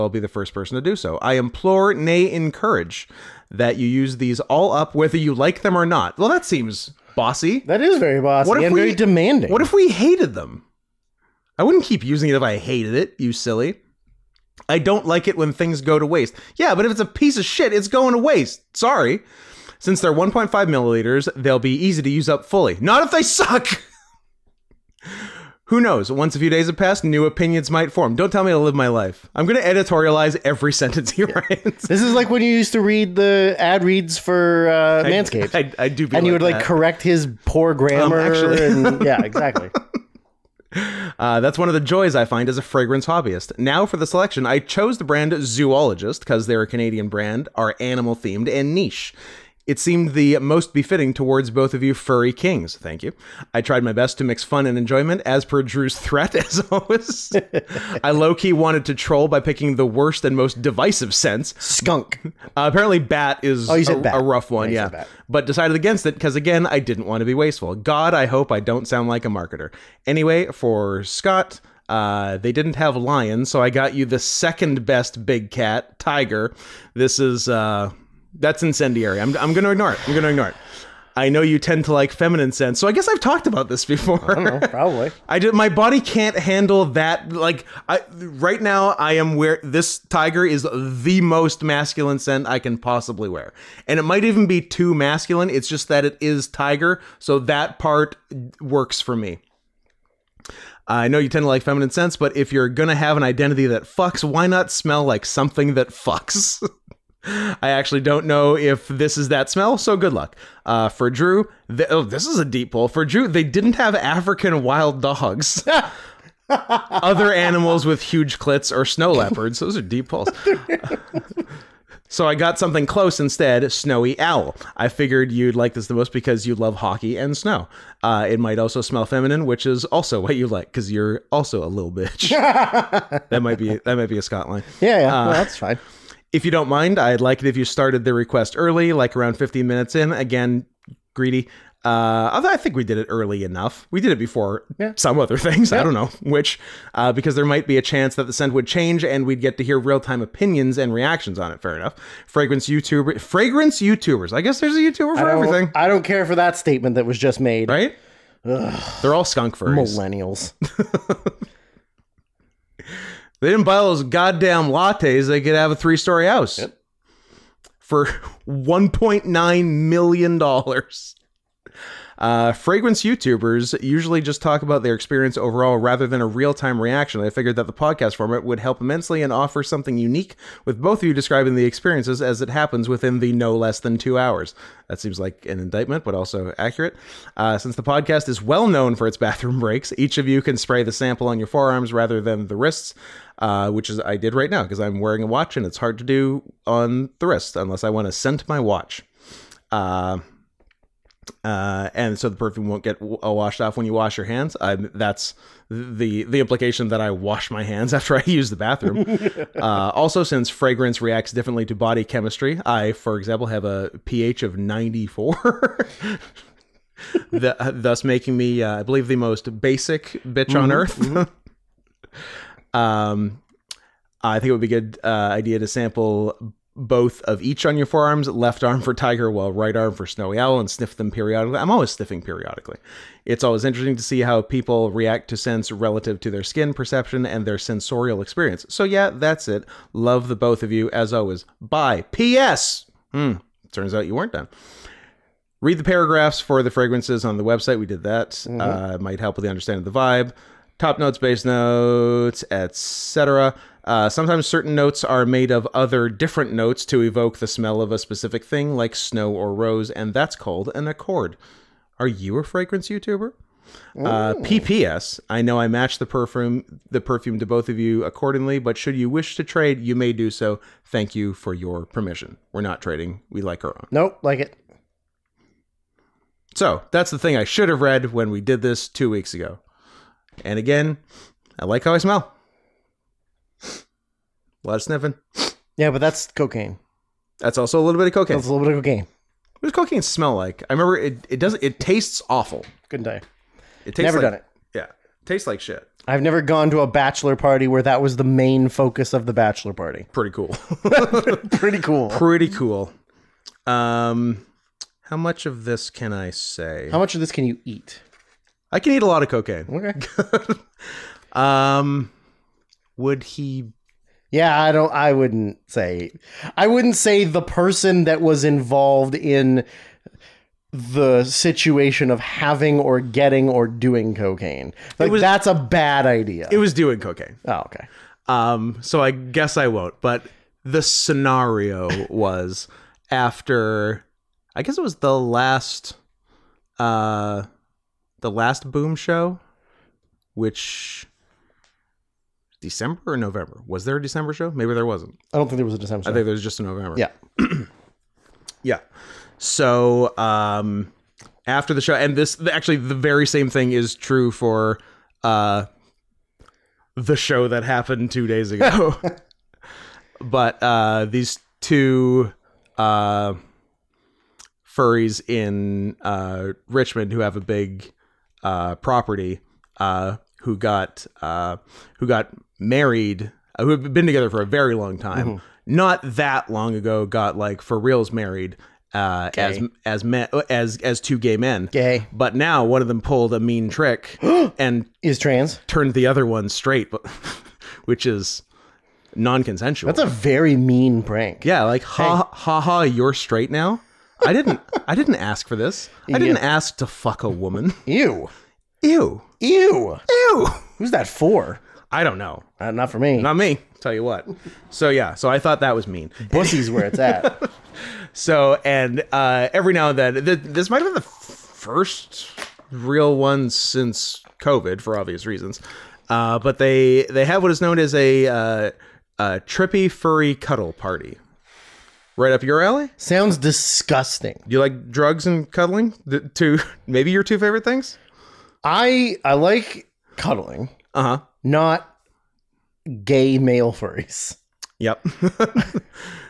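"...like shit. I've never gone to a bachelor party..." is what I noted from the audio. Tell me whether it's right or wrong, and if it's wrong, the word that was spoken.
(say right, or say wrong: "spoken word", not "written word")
right.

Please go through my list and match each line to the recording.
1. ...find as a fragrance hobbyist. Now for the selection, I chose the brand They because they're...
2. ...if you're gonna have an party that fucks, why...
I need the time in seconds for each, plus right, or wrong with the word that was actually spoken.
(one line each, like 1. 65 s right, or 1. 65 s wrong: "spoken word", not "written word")
1. 42 s wrong: "Zoologist", not "They"
2. 102 s wrong: "identity", not "party".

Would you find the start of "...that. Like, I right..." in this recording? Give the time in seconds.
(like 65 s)
86 s.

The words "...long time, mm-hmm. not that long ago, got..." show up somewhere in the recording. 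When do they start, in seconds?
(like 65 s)
374 s.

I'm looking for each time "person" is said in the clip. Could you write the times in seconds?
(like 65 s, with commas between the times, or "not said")
0 s, 317 s.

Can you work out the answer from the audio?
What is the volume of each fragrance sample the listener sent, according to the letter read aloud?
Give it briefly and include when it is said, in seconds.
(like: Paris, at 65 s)
1.5 milliliters, at 20 s.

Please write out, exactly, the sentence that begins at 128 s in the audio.
Uh, it might also smell feminine, which is also what you like because you're also a little bitch.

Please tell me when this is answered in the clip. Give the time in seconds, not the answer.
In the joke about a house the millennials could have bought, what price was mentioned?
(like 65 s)
168 s.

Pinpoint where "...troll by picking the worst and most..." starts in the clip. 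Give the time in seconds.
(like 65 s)
58 s.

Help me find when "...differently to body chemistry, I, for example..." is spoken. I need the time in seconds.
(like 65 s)
211 s.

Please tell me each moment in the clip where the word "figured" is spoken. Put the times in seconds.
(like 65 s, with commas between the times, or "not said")
124 s, 177 s.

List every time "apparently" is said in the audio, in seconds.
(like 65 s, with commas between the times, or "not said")
62 s.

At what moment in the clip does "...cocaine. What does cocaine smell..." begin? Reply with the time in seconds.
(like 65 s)
288 s.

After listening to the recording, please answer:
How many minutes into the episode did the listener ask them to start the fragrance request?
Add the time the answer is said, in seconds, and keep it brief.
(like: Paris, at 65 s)
15 minutes, at 139 s.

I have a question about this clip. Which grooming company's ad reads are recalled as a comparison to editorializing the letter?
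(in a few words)
Manscaped.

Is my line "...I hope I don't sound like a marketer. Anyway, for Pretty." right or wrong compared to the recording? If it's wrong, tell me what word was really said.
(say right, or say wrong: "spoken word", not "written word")
wrong: "Scott", not "Pretty".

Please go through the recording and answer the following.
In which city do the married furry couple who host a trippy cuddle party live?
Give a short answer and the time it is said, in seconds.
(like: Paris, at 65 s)
Richmond, at 366 s.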